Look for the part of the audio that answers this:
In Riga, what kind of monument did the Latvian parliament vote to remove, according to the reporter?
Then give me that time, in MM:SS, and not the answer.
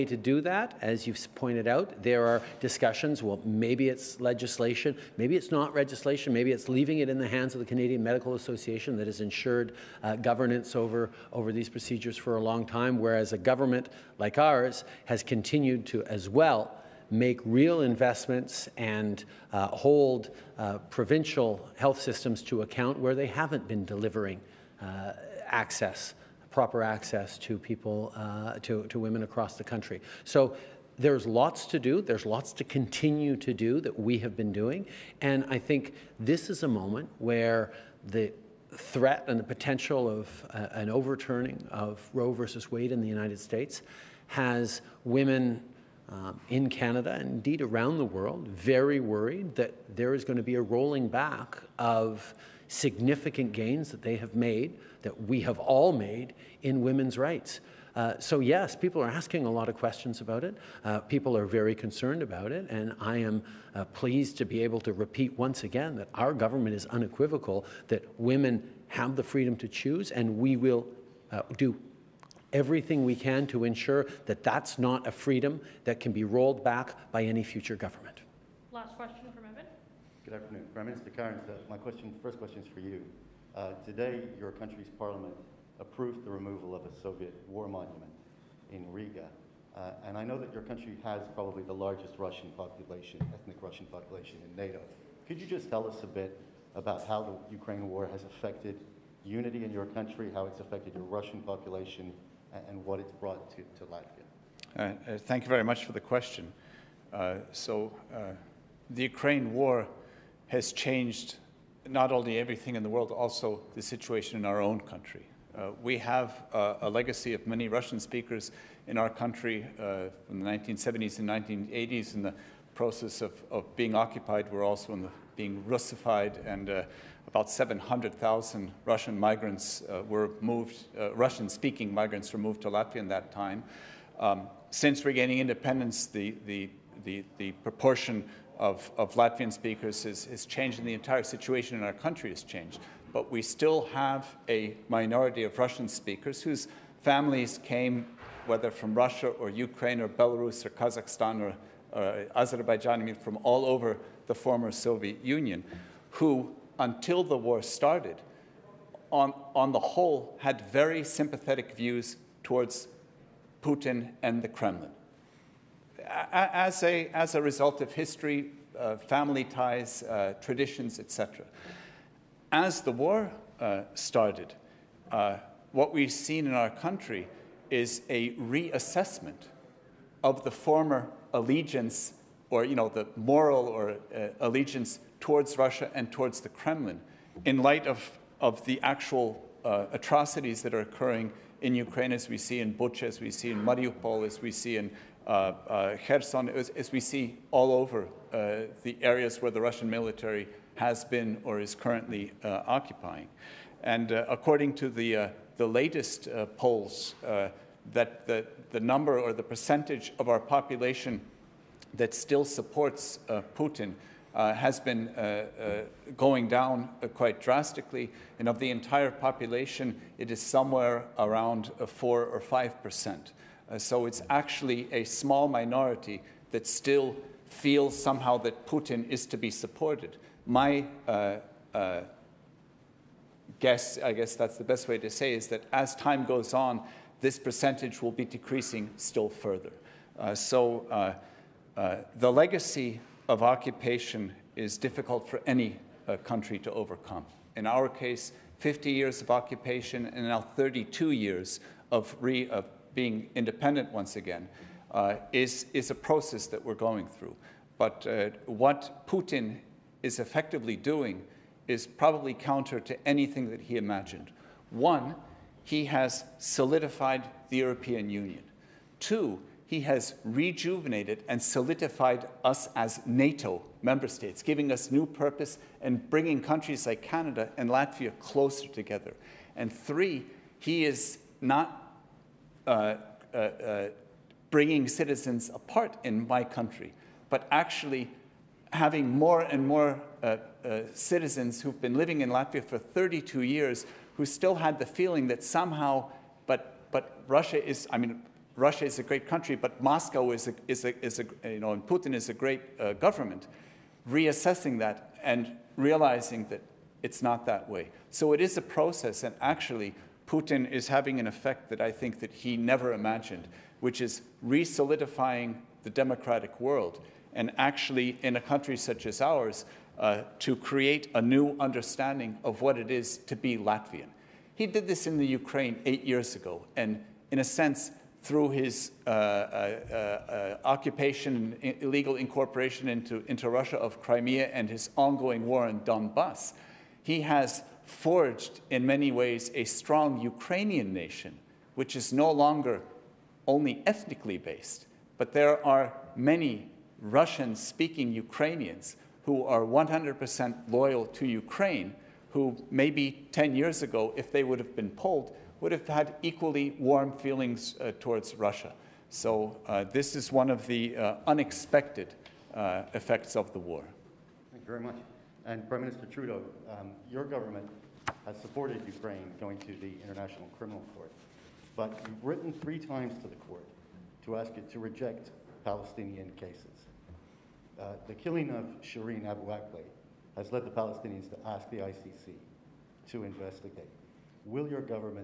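01:27.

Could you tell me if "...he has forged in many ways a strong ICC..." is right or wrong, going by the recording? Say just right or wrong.
wrong.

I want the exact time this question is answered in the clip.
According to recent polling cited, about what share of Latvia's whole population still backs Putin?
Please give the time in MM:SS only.
03:41.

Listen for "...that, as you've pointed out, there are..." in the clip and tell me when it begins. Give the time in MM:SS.
00:00.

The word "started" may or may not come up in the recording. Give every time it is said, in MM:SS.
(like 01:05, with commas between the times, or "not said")
02:37, 02:53.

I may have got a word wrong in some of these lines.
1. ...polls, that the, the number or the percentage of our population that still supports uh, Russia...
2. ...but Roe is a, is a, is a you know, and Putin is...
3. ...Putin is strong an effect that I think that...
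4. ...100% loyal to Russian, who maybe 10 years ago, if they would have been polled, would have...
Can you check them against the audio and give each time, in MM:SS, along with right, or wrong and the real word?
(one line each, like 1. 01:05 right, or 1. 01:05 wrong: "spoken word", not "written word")
1. 03:26 wrong: "Putin", not "Russia"
2. 04:59 wrong: "Moscow", not "Roe"
3. 05:10 wrong: "having", not "strong"
4. 05:49 wrong: "Ukraine", not "Russian".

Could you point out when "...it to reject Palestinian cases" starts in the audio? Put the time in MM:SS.
06:14.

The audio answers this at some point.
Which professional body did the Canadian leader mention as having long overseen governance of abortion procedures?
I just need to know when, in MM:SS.
00:07.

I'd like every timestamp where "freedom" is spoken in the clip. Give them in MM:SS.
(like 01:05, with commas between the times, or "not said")
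01:09, 01:15.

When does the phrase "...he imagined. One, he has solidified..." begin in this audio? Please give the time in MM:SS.
04:23.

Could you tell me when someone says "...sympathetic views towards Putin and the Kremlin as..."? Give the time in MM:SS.
02:41.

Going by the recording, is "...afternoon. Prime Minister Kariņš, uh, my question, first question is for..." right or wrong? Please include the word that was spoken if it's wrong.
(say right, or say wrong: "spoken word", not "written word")
right.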